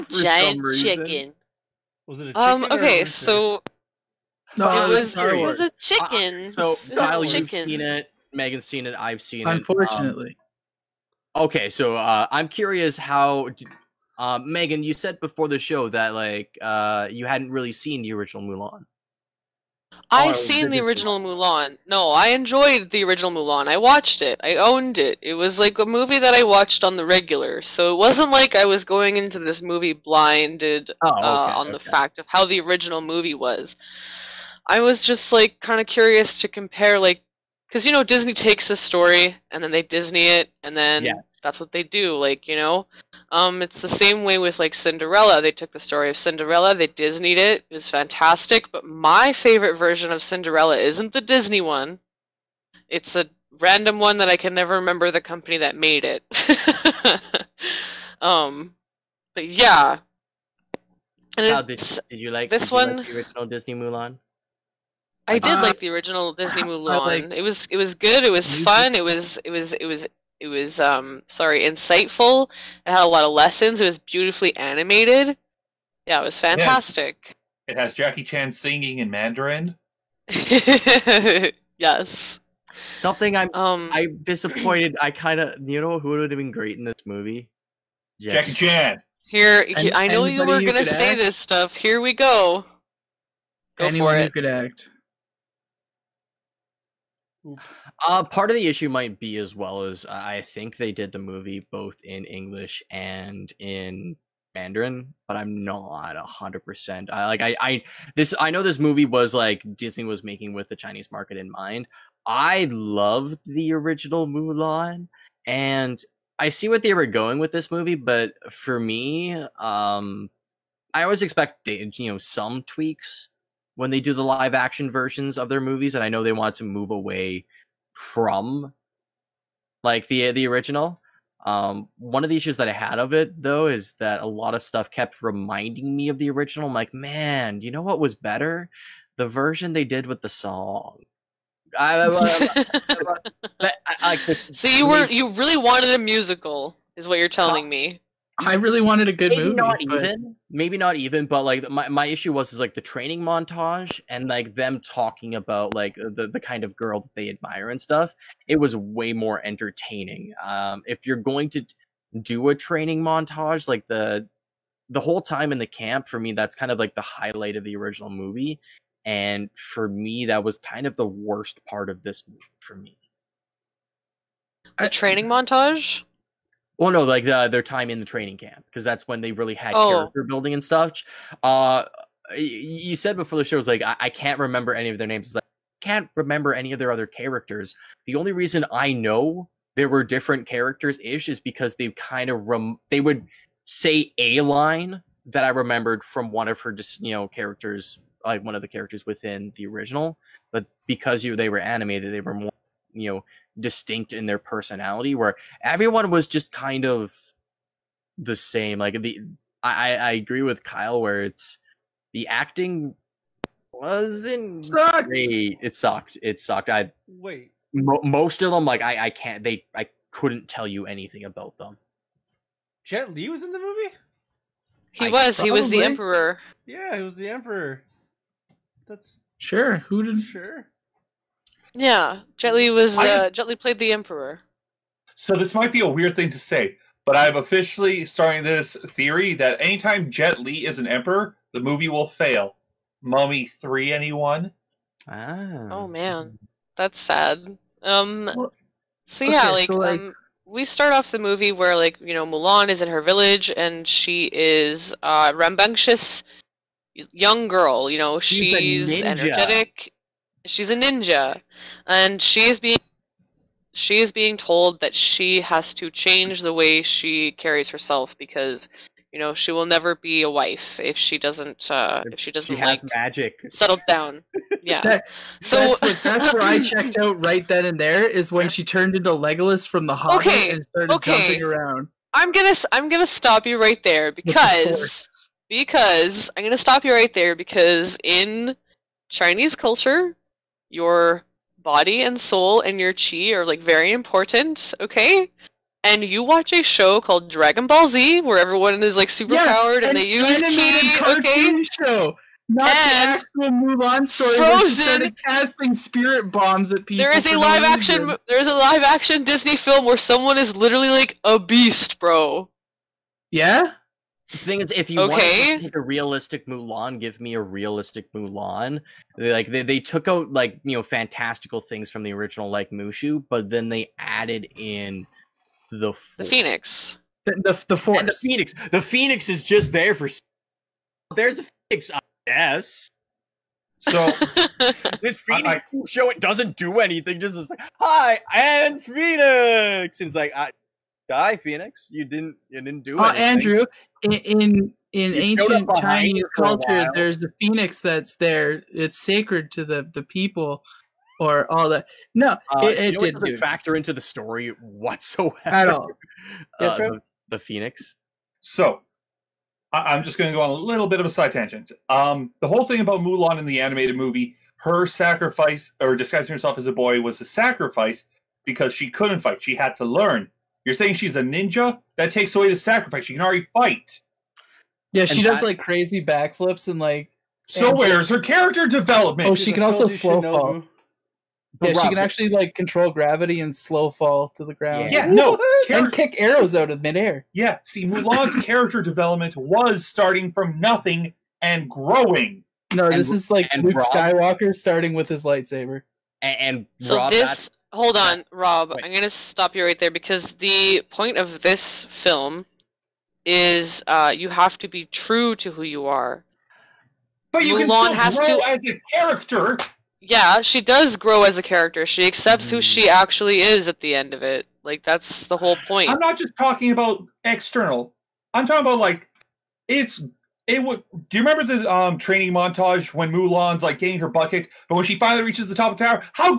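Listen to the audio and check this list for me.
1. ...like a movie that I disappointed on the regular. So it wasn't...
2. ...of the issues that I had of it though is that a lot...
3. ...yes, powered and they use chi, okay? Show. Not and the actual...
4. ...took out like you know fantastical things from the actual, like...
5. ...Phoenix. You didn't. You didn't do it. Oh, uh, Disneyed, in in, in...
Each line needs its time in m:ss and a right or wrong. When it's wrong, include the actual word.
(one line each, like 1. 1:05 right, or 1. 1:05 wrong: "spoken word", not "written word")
1. 0:25 wrong: "watched", not "disappointed"
2. 2:12 right
3. 4:59 right
4. 5:19 wrong: "original", not "actual"
5. 5:41 wrong: "Andrew", not "Disneyed".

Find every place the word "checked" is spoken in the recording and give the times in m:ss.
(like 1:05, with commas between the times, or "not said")
4:36.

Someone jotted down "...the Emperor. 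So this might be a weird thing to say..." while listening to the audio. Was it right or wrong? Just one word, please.
right.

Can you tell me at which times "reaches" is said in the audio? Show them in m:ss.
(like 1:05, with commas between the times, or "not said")
7:05.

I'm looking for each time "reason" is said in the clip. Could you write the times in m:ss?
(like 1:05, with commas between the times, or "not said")
0:00, 3:08, 5:08.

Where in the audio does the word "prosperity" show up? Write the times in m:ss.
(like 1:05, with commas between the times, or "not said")
not said.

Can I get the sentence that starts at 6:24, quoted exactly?
Yeah, no, Char- and kick arrows out of midair.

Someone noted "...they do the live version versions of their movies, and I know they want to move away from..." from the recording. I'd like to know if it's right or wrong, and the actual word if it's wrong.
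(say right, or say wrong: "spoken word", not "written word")
wrong: "action", not "version".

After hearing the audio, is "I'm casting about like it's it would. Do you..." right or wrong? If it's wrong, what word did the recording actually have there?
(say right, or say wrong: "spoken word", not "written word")
wrong: "talking", not "casting".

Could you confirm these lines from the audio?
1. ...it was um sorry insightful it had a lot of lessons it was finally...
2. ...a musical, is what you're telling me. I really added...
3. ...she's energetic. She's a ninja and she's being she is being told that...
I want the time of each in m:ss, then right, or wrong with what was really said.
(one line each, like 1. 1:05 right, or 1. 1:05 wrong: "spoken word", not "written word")
1. 1:10 wrong: "beautifully", not "finally"
2. 2:25 wrong: "wanted", not "added"
3. 4:18 right.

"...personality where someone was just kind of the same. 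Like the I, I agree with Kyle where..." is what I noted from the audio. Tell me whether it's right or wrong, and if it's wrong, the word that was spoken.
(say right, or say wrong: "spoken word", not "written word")
wrong: "everyone", not "someone".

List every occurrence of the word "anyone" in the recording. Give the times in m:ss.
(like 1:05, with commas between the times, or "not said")
1:33, 4:03.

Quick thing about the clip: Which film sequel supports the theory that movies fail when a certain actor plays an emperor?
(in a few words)
Mummy three.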